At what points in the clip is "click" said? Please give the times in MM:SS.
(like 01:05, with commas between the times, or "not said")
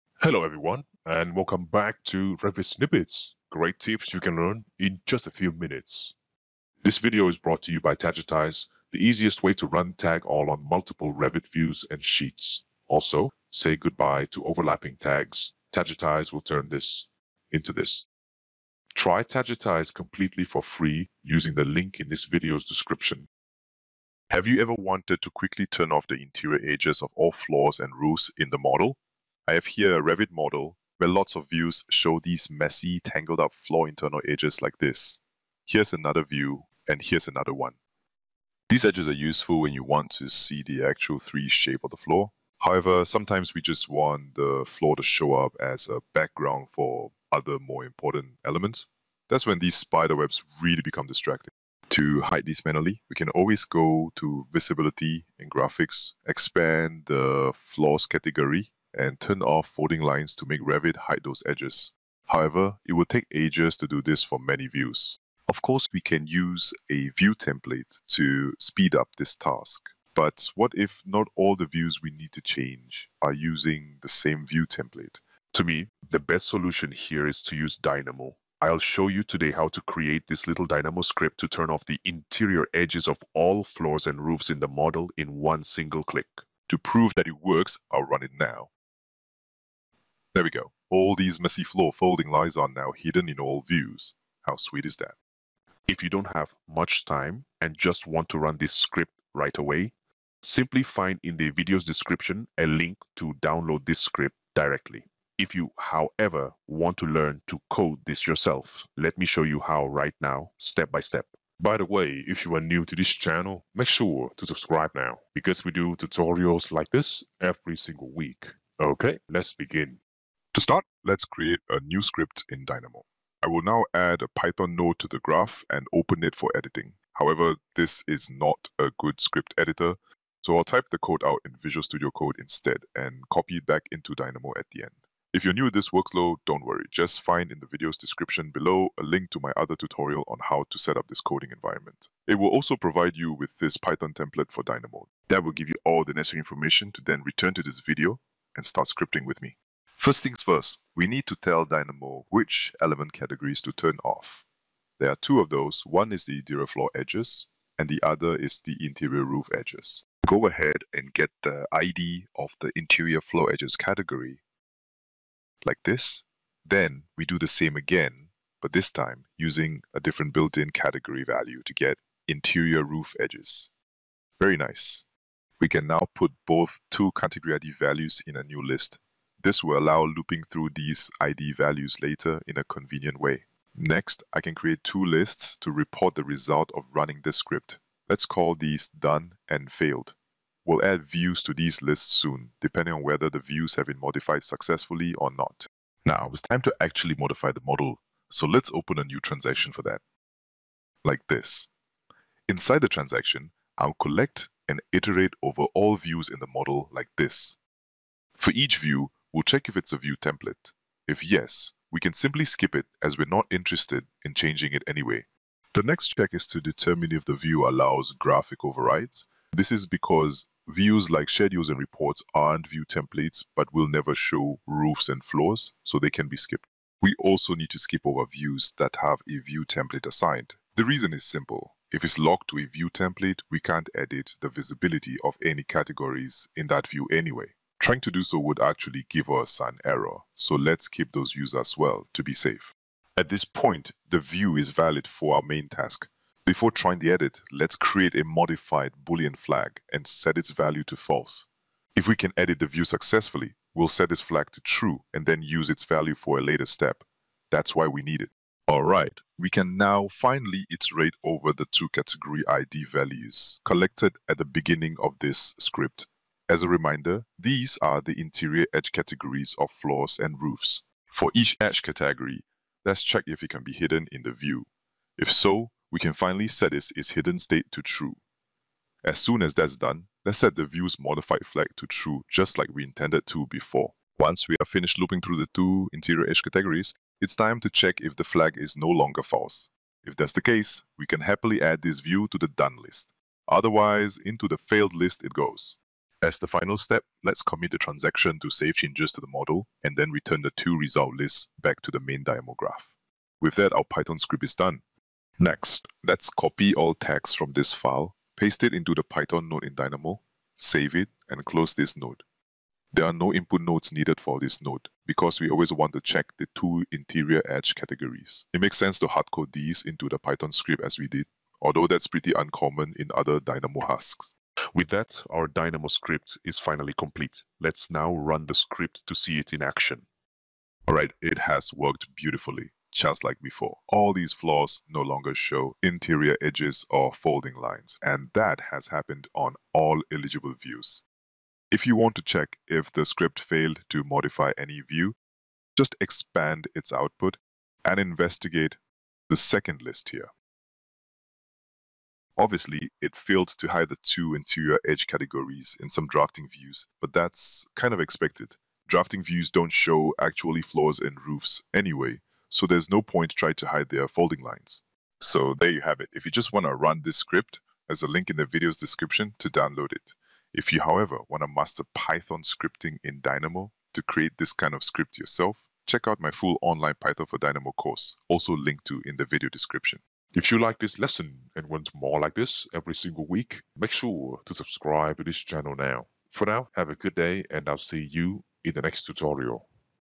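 01:26.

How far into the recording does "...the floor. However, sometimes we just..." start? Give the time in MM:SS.
00:41.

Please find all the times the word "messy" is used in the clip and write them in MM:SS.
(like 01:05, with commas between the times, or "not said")
00:32, 01:31.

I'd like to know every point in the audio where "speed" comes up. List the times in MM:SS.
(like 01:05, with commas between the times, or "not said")
01:08.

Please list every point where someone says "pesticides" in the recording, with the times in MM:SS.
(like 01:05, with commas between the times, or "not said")
not said.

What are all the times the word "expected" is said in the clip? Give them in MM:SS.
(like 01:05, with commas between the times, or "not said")
05:57.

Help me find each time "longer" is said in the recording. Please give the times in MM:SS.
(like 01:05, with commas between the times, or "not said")
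04:48, 05:35.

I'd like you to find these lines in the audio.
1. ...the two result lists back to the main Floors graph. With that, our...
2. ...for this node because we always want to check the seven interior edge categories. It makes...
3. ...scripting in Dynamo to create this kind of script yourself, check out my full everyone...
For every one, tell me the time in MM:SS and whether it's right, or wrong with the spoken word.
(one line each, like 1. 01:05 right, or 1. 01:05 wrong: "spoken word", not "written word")
1. 05:00 wrong: "Dynamo", not "Floors"
2. 05:14 wrong: "two", not "seven"
3. 06:12 wrong: "online", not "everyone".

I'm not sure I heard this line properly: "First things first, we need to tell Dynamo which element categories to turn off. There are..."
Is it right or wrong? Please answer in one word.
right.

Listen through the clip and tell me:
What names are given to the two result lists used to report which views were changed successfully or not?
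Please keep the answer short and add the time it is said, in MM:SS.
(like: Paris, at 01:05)
done and failed, at 03:08.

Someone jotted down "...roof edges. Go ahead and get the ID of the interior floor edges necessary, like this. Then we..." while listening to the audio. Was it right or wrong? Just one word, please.
wrong.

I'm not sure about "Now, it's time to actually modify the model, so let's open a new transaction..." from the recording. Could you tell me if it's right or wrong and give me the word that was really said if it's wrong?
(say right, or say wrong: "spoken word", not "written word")
right.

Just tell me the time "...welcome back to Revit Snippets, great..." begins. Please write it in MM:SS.
00:01.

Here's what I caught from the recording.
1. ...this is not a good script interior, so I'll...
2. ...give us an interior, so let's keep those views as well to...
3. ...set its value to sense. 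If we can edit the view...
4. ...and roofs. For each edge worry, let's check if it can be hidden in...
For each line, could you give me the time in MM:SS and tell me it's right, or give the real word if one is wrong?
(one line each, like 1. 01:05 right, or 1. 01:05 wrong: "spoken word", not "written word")
1. 02:07 wrong: "editor", not "interior"
2. 03:59 wrong: "error", not "interior"
3. 04:10 wrong: "false", not "sense"
4. 04:30 wrong: "category", not "worry".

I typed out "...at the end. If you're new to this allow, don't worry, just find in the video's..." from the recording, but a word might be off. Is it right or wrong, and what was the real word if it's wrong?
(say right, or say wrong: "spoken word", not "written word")
wrong: "workflow", not "allow".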